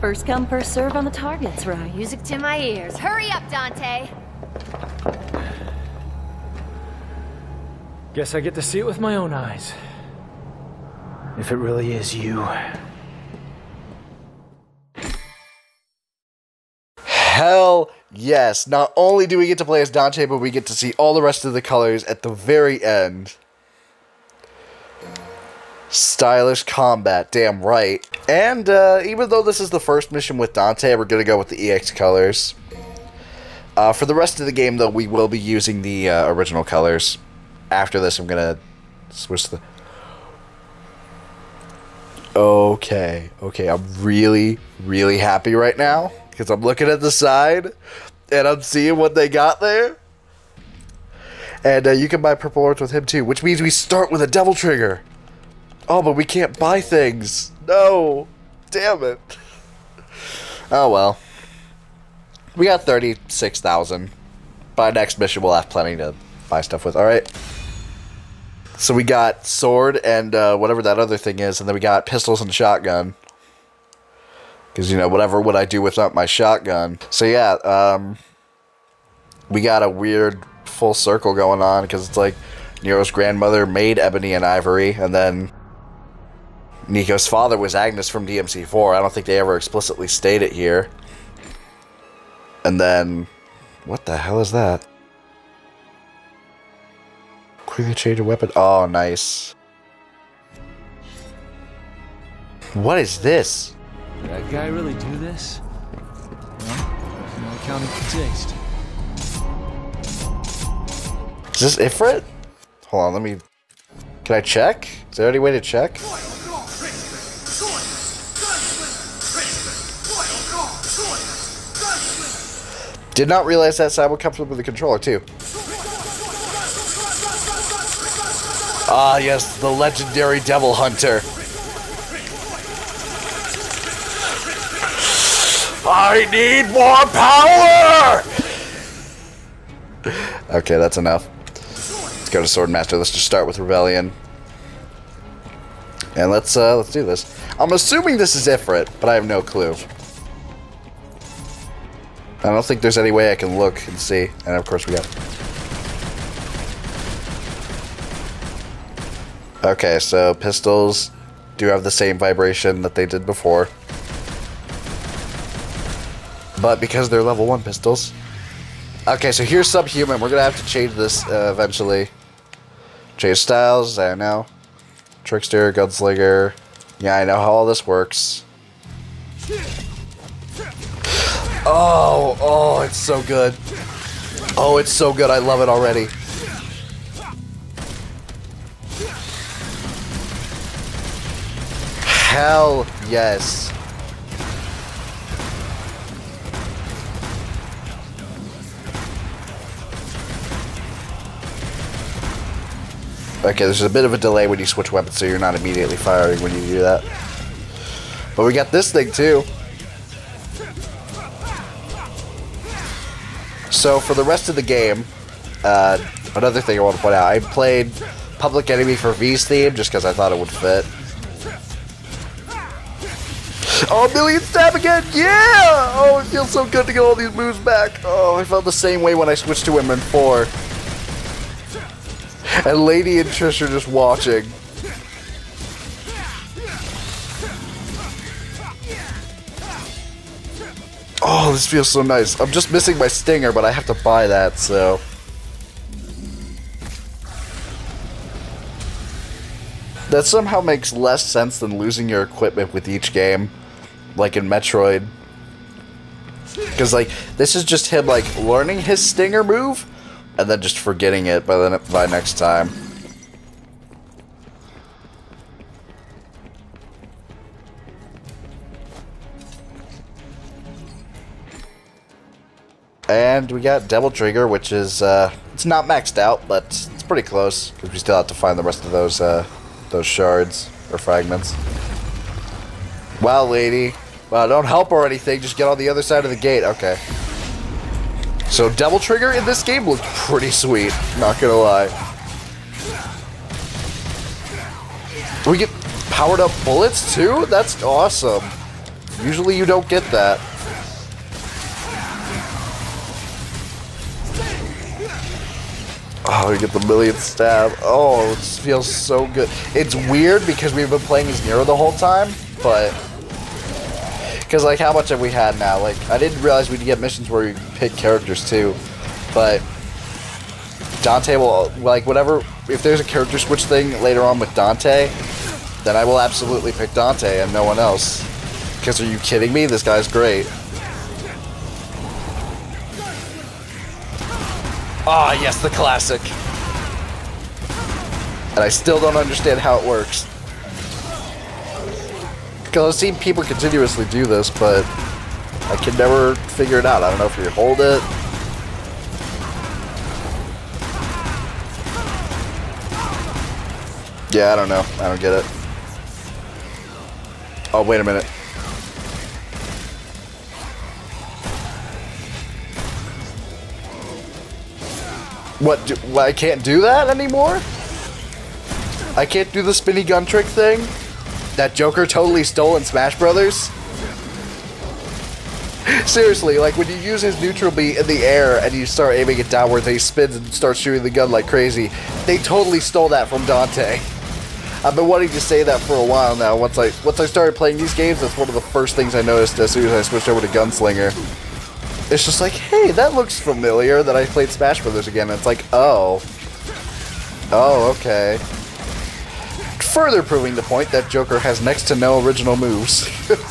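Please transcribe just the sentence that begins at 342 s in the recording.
Because I've seen people continuously do this, but I can never figure it out.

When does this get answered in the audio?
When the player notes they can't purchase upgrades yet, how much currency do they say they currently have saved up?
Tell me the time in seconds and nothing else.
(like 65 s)
62 s.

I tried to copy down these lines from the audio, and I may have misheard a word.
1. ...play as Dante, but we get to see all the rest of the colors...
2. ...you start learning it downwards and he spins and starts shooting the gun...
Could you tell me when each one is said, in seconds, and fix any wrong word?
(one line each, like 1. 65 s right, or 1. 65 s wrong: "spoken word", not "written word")
1. 19 s right
2. 378 s wrong: "aiming", not "learning".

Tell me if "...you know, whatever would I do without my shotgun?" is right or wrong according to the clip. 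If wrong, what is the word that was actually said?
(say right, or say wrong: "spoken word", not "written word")
right.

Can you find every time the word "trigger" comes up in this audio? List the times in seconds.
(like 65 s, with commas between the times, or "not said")
54 s, 274 s, 289 s.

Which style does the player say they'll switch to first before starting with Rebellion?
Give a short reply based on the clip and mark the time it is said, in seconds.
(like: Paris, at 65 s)
Swordmaster, at 142 s.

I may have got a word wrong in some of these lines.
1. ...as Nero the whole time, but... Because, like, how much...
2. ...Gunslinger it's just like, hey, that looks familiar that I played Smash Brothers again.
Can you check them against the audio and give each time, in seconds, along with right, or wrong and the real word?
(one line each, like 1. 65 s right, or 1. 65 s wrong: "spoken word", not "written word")
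1. 311 s right
2. 390 s right.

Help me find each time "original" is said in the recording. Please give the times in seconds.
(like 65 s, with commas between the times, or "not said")
36 s, 402 s.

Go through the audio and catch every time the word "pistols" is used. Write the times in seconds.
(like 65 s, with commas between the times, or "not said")
72 s, 160 s, 167 s.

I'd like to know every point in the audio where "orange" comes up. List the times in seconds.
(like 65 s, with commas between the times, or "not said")
52 s.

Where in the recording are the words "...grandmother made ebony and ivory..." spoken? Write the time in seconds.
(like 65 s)
83 s.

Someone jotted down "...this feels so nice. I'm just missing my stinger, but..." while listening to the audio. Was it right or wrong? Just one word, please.
right.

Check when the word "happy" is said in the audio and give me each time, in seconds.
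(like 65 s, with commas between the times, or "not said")
45 s.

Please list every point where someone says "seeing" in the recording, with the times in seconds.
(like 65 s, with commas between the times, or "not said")
48 s.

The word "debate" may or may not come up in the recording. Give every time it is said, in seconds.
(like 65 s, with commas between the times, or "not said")
not said.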